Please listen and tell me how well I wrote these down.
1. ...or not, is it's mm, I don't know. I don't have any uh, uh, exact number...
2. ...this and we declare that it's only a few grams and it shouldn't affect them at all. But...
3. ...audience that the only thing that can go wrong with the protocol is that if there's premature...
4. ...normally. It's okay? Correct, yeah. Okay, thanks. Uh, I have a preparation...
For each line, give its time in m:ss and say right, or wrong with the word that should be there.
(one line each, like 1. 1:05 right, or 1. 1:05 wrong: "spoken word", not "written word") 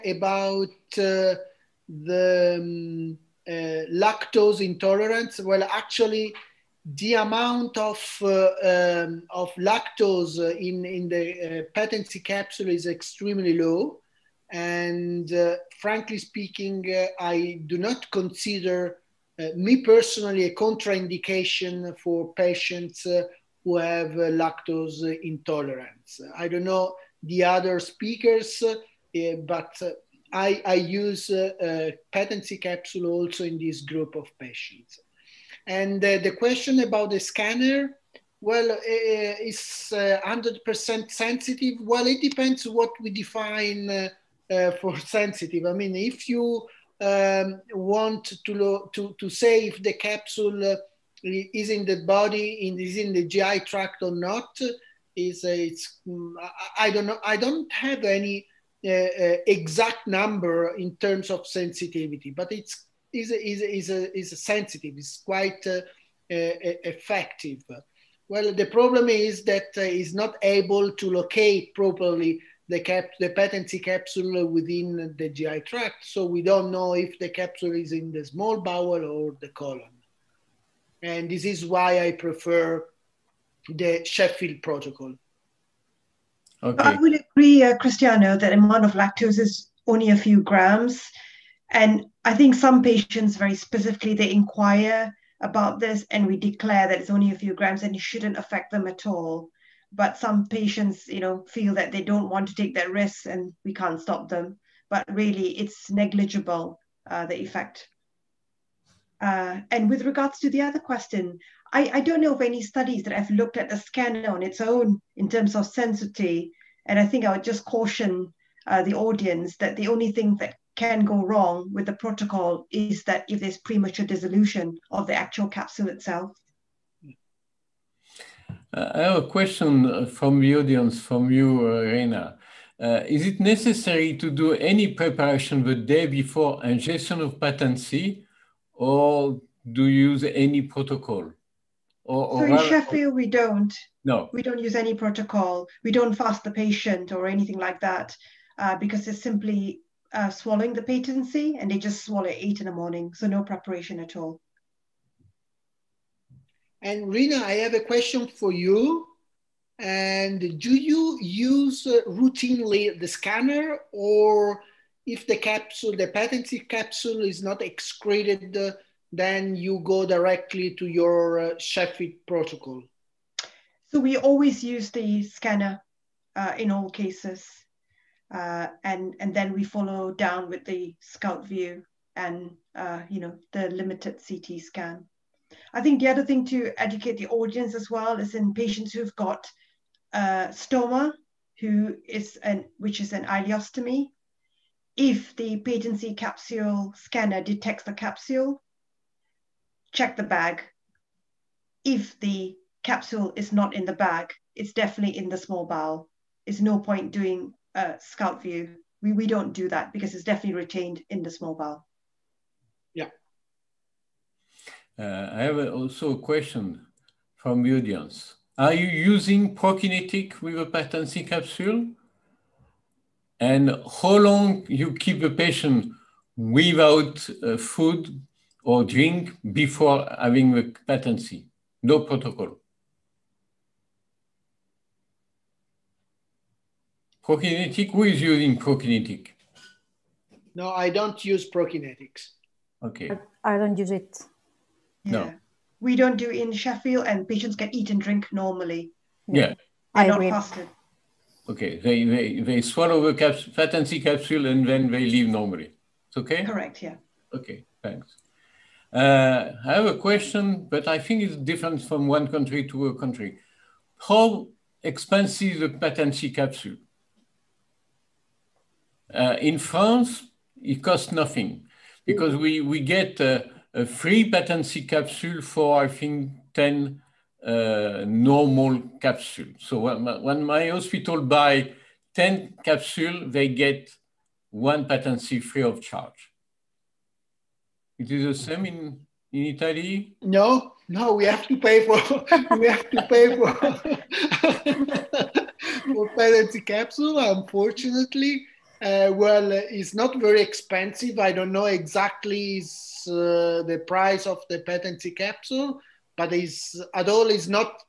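1. 0:54 right
2. 1:35 right
3. 1:58 right
4. 4:15 wrong: "question", not "preparation".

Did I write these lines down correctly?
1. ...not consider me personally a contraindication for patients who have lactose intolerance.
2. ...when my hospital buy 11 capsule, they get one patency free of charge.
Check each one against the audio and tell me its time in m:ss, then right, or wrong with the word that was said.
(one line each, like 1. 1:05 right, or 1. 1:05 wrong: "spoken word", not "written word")
1. 0:17 right
2. 4:40 wrong: "10", not "11".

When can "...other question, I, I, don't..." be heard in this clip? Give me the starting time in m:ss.
1:50.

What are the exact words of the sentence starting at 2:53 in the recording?
So we always use the scanner uh, in all cases.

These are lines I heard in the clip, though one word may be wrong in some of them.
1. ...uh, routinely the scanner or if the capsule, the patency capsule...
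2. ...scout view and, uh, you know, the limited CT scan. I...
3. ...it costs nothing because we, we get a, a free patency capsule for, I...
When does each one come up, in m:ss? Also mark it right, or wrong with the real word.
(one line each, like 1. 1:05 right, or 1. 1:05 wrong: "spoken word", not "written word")
1. 2:41 right
2. 3:01 right
3. 4:30 right.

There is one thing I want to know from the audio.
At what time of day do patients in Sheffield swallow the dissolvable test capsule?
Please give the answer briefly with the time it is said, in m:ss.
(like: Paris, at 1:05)
8 in the morning, at 2:32.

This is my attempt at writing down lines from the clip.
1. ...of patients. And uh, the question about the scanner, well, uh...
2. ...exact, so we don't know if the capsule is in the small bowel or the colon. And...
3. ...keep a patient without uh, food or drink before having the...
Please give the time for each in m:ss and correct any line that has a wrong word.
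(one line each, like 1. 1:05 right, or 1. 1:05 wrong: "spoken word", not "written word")
1. 0:34 right
2. 1:15 wrong: "tract", not "exact"
3. 3:44 right.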